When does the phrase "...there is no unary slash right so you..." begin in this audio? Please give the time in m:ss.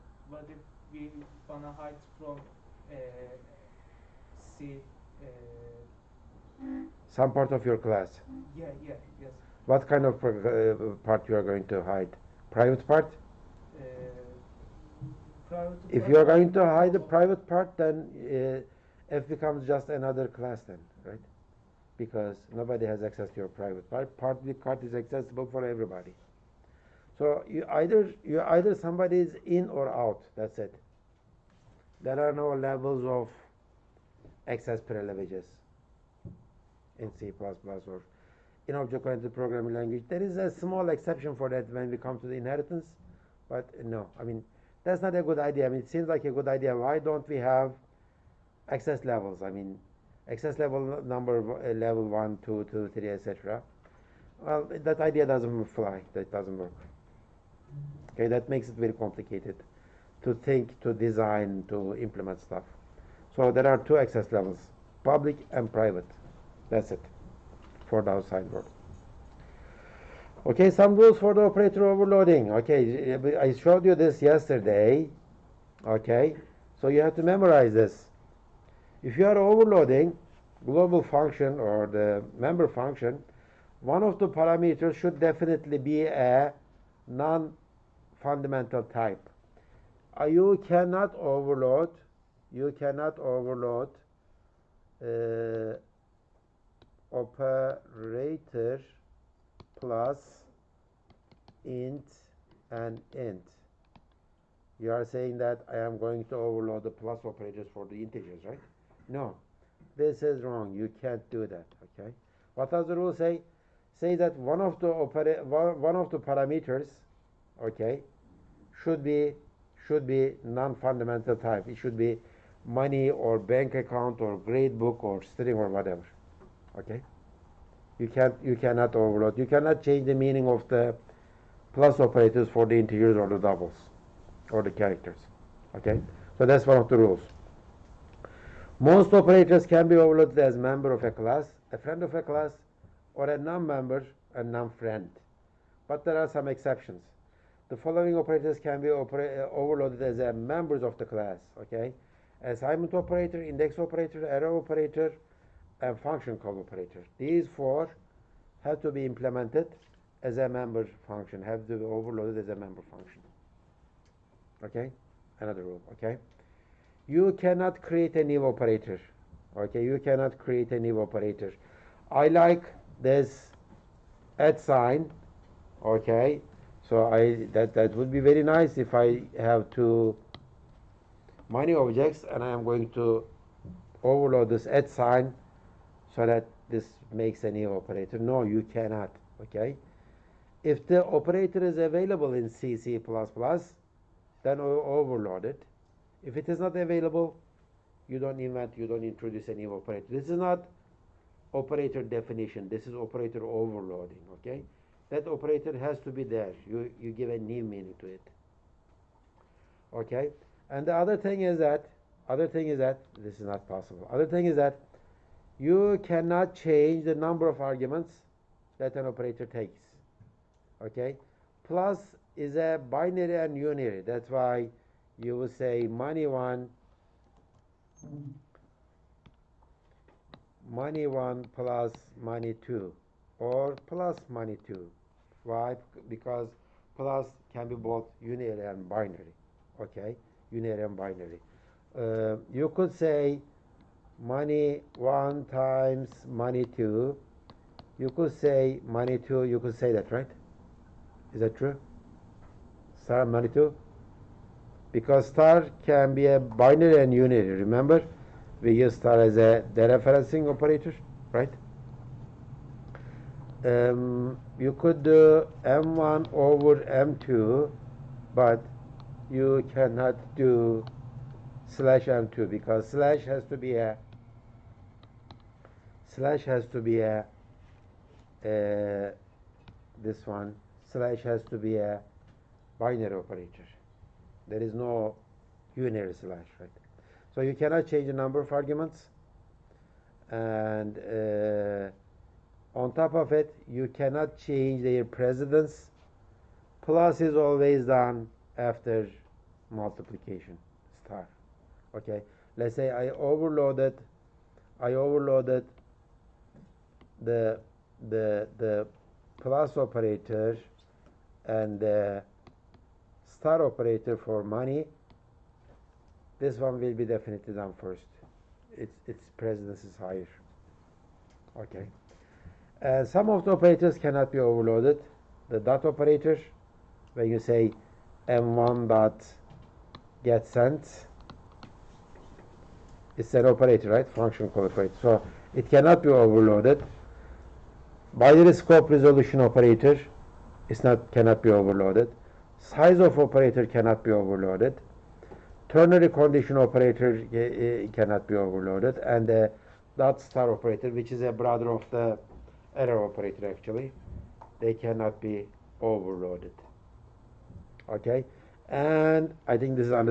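4:44.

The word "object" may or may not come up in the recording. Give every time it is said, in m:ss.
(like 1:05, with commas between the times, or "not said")
0:38, 3:01.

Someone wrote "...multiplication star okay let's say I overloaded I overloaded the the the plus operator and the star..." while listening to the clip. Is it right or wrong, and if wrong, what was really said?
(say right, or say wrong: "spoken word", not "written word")
right.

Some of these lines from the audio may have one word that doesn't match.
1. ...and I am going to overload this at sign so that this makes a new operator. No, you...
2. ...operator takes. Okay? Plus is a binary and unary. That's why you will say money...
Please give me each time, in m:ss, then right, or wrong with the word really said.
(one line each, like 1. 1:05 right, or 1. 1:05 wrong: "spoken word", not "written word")
1. 3:02 right
2. 3:39 right.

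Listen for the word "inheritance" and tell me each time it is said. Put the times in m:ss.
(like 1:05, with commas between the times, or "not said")
0:42.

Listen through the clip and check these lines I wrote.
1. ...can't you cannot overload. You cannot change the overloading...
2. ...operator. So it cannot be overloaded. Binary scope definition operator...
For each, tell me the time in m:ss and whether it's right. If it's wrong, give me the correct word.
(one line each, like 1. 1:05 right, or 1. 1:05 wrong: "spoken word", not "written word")
1. 2:08 wrong: "meaning", not "overloading"
2. 5:34 wrong: "resolution", not "definition".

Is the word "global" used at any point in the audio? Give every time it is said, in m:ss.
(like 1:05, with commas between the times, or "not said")
1:20.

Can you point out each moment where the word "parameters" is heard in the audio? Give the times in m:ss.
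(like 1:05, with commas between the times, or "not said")
1:24, 1:56.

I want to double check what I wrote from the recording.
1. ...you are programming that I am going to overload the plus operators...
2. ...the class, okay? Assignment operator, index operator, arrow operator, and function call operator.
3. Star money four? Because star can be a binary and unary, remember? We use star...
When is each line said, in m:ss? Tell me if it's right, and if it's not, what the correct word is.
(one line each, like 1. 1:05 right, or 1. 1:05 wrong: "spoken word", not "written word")
1. 1:44 wrong: "saying", not "programming"
2. 2:30 right
3. 4:13 wrong: "two", not "four".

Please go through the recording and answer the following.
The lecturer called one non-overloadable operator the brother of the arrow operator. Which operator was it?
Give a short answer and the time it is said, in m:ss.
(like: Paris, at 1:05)
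dot star operator, at 5:49.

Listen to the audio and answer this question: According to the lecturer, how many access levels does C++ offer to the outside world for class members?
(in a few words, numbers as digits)
2.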